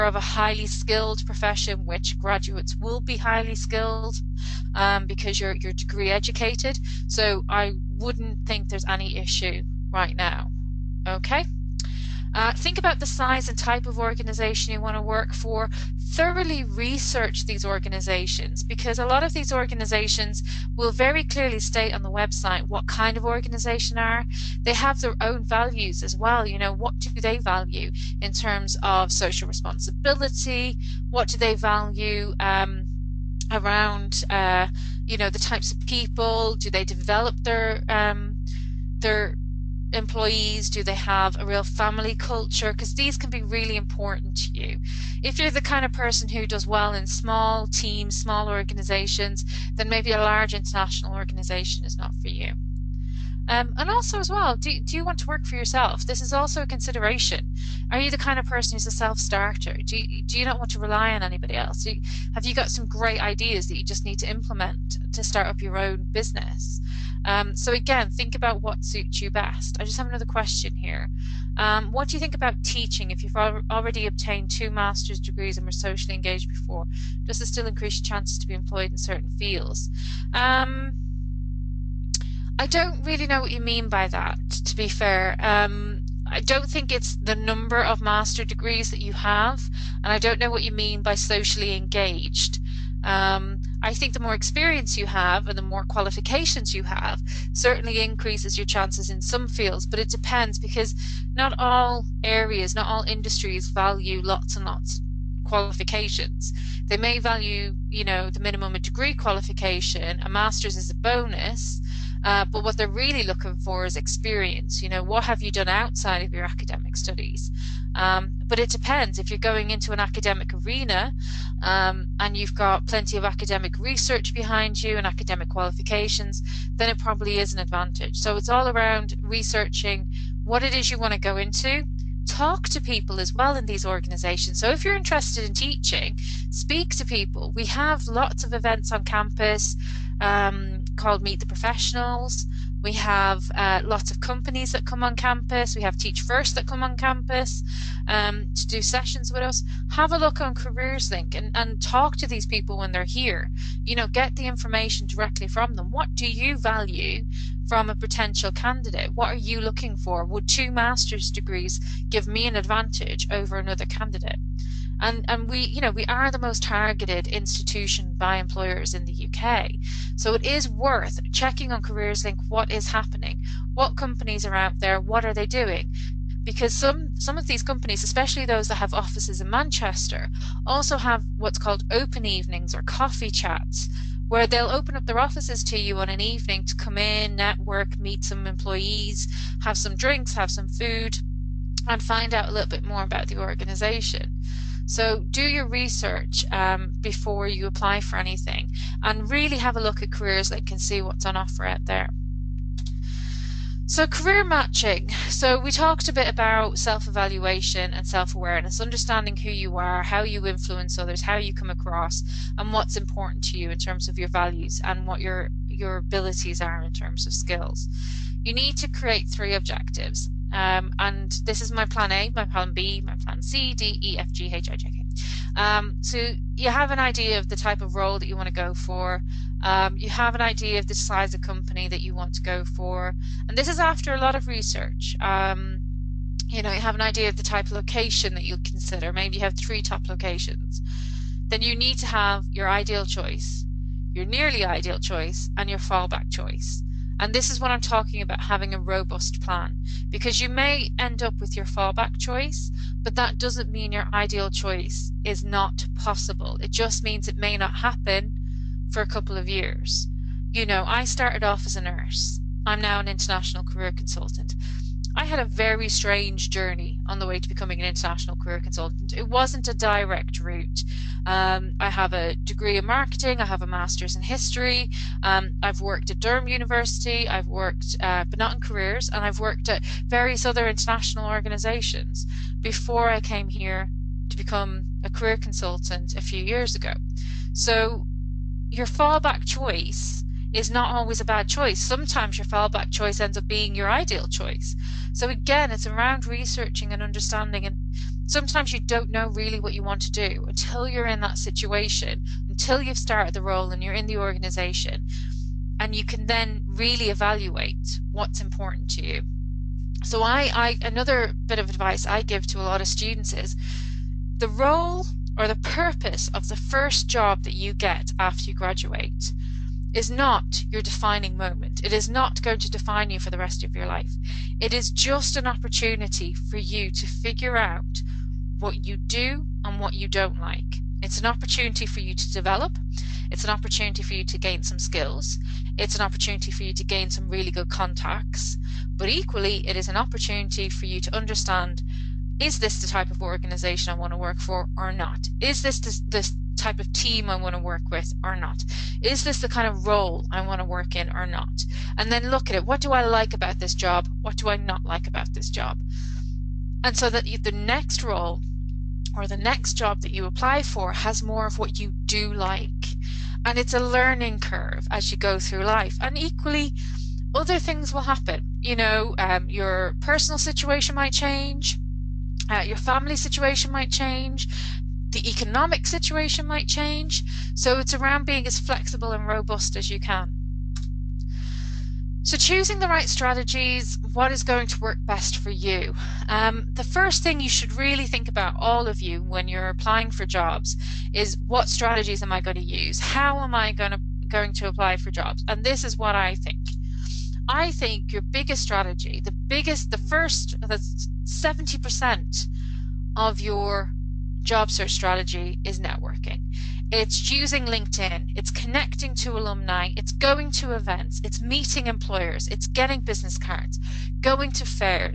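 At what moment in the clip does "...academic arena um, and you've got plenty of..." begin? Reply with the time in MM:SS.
02:00.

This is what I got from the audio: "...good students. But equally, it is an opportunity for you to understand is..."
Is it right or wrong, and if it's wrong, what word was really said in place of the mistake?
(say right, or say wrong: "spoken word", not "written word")
wrong: "contacts", not "students".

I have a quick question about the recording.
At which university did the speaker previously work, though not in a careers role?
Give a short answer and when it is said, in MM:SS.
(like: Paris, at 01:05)
Durham University, at 04:36.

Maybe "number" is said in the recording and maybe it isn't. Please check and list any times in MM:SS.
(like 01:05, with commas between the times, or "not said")
01:27.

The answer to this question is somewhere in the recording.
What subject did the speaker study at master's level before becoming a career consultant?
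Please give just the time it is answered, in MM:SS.
04:34.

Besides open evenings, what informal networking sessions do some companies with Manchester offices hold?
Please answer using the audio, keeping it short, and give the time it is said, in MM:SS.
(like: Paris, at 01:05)
coffee chats, at 03:02.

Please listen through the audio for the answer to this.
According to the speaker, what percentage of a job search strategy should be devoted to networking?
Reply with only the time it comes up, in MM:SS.
06:41.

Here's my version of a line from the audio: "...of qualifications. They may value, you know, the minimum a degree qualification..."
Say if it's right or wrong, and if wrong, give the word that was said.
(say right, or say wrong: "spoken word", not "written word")
right.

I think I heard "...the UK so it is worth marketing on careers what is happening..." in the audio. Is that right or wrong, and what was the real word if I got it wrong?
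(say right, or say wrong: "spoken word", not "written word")
wrong: "checking", not "marketing".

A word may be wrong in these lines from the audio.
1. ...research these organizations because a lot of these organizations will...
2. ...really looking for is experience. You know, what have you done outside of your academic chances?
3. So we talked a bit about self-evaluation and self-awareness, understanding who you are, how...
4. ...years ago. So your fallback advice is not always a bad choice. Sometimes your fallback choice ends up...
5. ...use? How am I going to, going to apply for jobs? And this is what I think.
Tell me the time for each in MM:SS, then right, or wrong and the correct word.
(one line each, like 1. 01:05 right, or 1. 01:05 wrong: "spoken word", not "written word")
1. 00:16 right
2. 01:52 wrong: "studies", not "chances"
3. 03:25 right
4. 04:46 wrong: "choice", not "advice"
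5. 06:32 right.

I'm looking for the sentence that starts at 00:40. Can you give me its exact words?
Do they have a real family culture?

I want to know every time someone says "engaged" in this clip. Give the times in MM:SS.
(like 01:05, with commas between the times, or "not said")
01:16, 01:31.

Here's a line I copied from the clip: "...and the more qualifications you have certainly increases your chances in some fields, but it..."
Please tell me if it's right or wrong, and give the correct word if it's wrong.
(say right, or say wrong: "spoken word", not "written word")
right.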